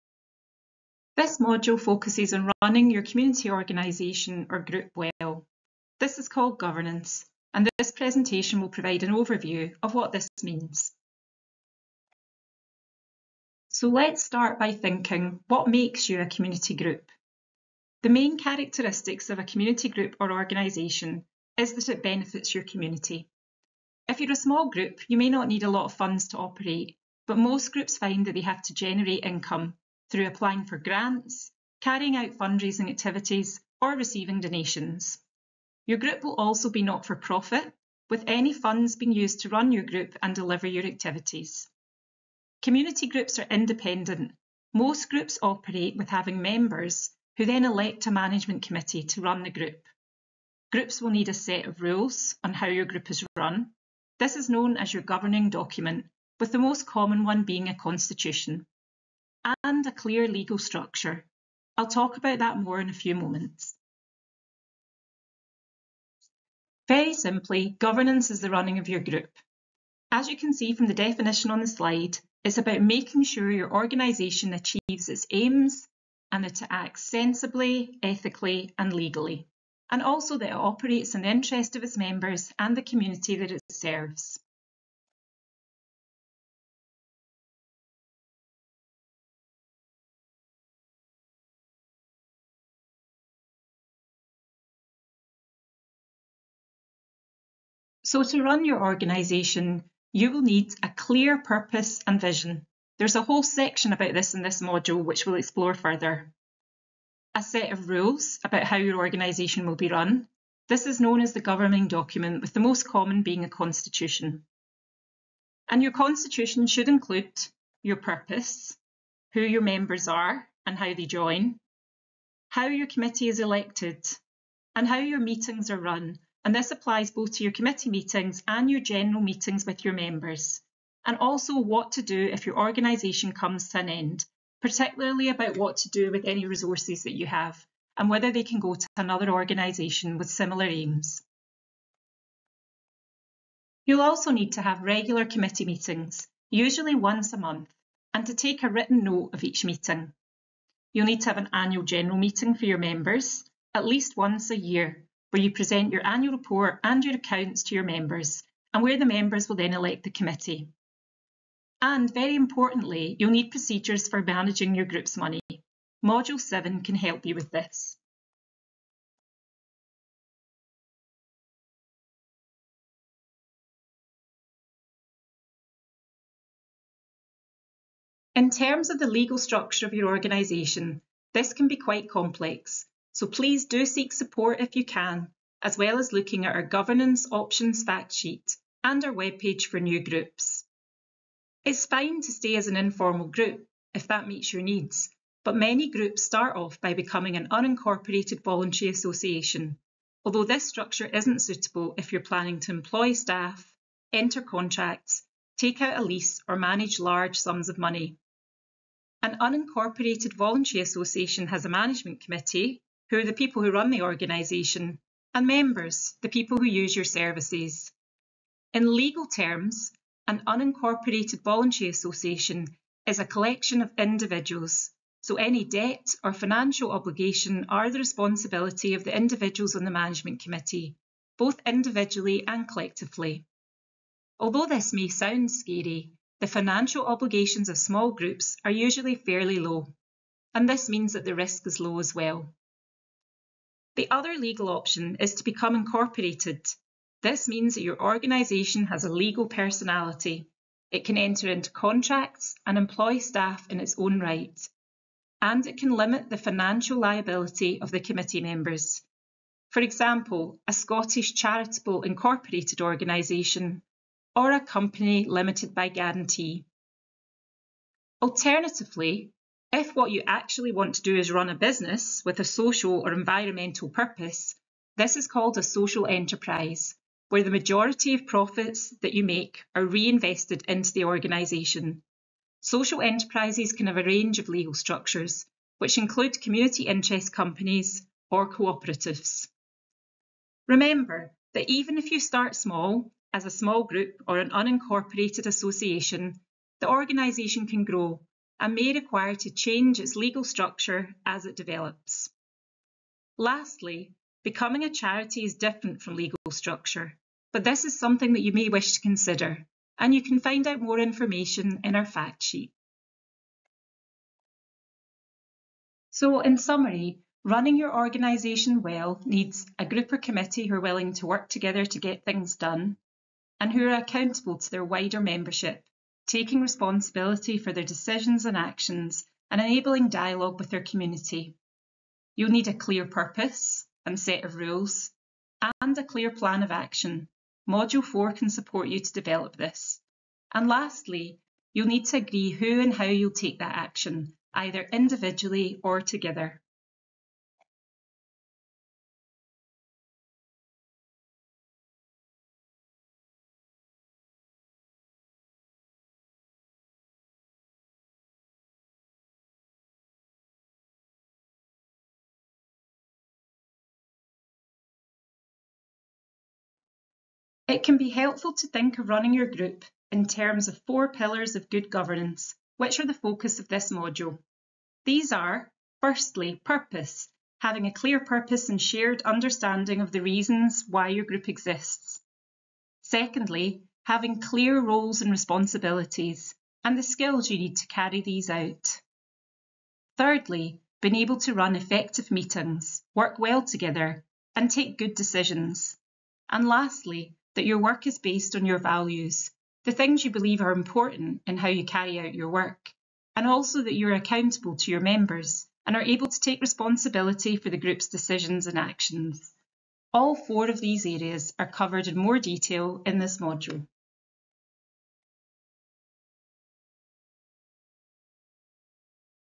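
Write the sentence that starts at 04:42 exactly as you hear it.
Social enterprises can have a range of legal structures, which include community interest companies or cooperatives.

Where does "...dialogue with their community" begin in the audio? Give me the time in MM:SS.
05:30.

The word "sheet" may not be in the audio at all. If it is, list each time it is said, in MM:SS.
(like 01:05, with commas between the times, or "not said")
03:08, 05:12.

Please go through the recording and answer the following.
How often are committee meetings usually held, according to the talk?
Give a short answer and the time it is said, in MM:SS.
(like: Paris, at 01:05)
once a month, at 02:26.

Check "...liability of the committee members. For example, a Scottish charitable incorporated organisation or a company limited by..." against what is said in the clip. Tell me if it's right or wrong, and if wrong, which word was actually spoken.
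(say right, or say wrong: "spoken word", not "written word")
right.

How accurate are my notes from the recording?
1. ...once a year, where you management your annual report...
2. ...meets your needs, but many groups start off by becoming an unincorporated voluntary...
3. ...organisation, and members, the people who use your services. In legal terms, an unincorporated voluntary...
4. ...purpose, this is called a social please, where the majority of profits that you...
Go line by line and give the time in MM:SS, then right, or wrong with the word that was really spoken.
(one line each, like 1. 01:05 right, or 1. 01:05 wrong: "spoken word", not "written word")
1. 02:34 wrong: "present", not "management"
2. 03:14 right
3. 03:34 right
4. 04:33 wrong: "enterprise", not "please".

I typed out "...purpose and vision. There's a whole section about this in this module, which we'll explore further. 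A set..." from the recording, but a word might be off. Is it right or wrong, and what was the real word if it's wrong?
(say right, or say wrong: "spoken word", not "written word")
right.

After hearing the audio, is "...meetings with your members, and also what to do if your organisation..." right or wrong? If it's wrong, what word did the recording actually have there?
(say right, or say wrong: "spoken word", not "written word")
right.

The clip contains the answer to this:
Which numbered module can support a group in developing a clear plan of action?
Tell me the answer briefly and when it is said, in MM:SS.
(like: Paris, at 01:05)
Module 4, at 05:37.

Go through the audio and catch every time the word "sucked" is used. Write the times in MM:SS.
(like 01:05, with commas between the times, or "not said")
not said.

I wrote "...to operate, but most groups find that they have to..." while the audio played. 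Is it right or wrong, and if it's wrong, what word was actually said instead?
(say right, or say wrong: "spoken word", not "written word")
right.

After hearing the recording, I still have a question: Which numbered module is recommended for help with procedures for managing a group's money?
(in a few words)
Module 7.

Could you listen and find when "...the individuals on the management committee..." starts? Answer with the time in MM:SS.
03:49.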